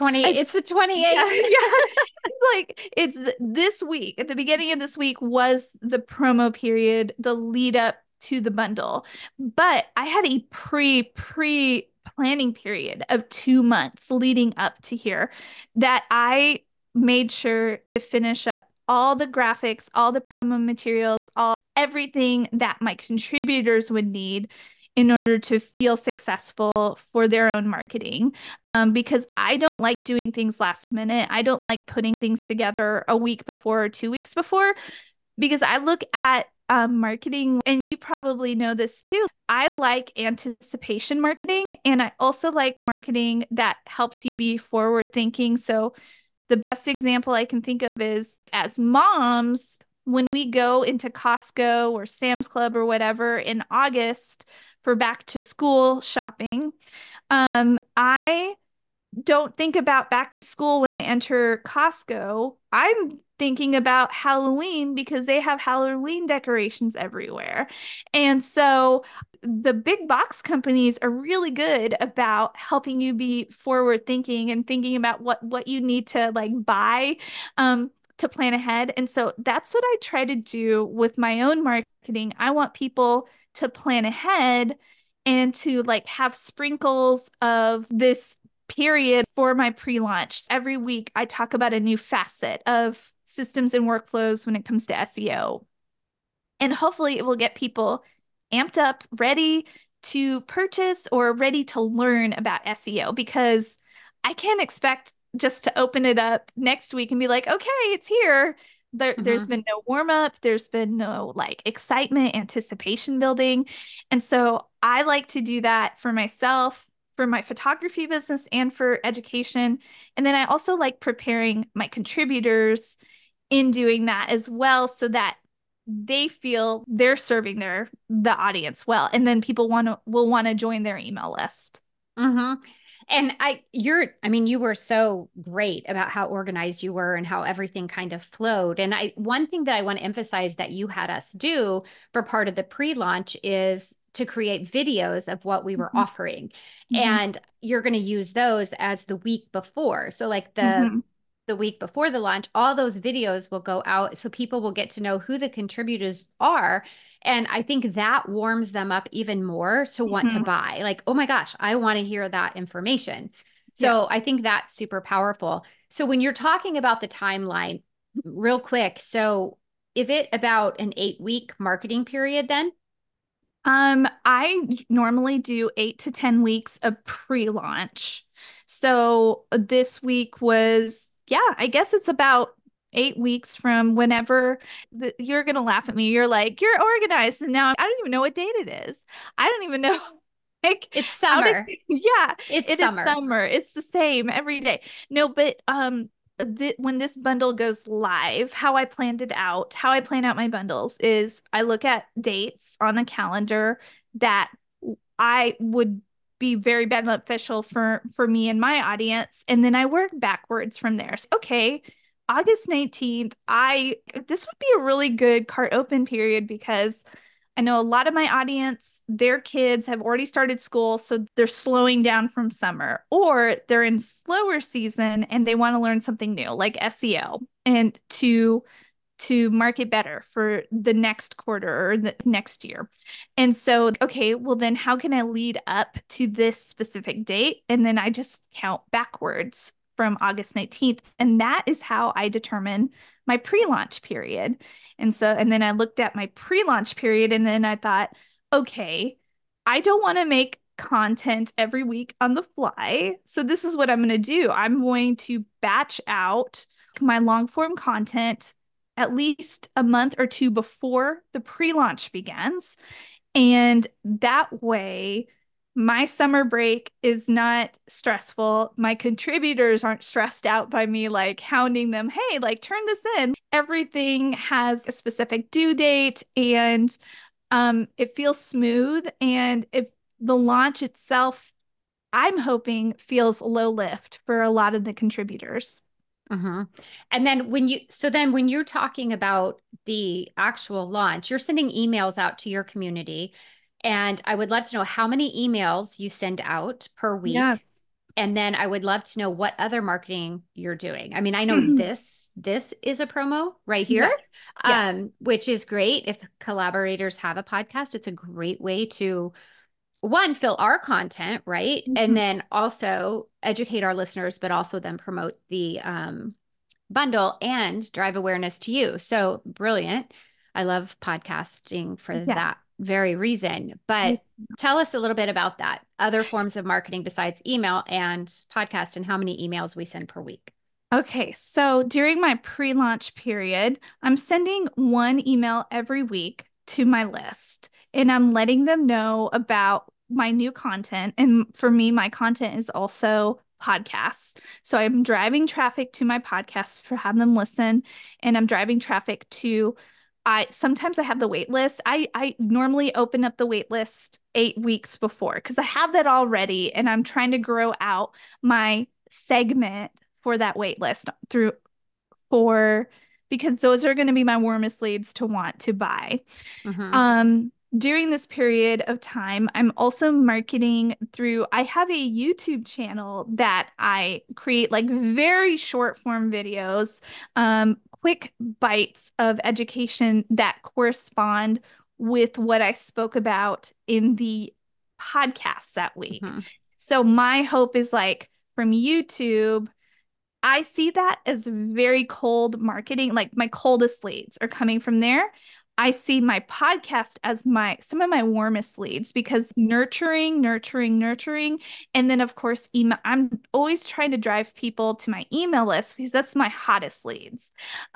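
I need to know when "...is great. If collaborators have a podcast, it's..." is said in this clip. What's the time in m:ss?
5:05.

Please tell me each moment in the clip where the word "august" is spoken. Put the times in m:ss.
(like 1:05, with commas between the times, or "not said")
0:53, 3:32, 4:00.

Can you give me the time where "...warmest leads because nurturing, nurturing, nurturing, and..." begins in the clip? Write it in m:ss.
6:38.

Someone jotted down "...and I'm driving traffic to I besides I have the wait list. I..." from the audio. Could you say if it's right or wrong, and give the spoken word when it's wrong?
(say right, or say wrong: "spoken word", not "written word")
wrong: "sometimes", not "besides".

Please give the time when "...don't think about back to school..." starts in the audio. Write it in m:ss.
0:59.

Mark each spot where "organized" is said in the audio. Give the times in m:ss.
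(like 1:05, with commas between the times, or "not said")
2:16, 3:06.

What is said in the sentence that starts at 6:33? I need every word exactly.
Like my coldest leads are coming from there.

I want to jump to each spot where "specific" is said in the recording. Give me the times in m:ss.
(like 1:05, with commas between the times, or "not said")
3:56, 4:34.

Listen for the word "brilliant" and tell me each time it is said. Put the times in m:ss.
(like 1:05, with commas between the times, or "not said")
5:19.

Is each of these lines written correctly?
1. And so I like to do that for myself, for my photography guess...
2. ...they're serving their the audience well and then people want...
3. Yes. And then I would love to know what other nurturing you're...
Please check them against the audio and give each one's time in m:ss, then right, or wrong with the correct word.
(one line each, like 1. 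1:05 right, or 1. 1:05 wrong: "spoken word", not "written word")
1. 1:54 wrong: "business", not "guess"
2. 2:06 right
3. 4:57 wrong: "marketing", not "nurturing".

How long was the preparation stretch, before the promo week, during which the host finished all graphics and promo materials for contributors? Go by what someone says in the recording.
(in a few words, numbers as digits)
2 months.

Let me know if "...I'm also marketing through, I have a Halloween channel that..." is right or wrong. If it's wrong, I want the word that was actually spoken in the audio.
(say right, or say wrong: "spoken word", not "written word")
wrong: "YouTube", not "Halloween".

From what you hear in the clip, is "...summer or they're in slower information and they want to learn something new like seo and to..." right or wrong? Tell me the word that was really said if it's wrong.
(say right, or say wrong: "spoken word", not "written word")
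wrong: "season", not "information".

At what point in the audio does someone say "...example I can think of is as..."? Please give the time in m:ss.
0:46.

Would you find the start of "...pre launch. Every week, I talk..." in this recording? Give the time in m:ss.
1:29.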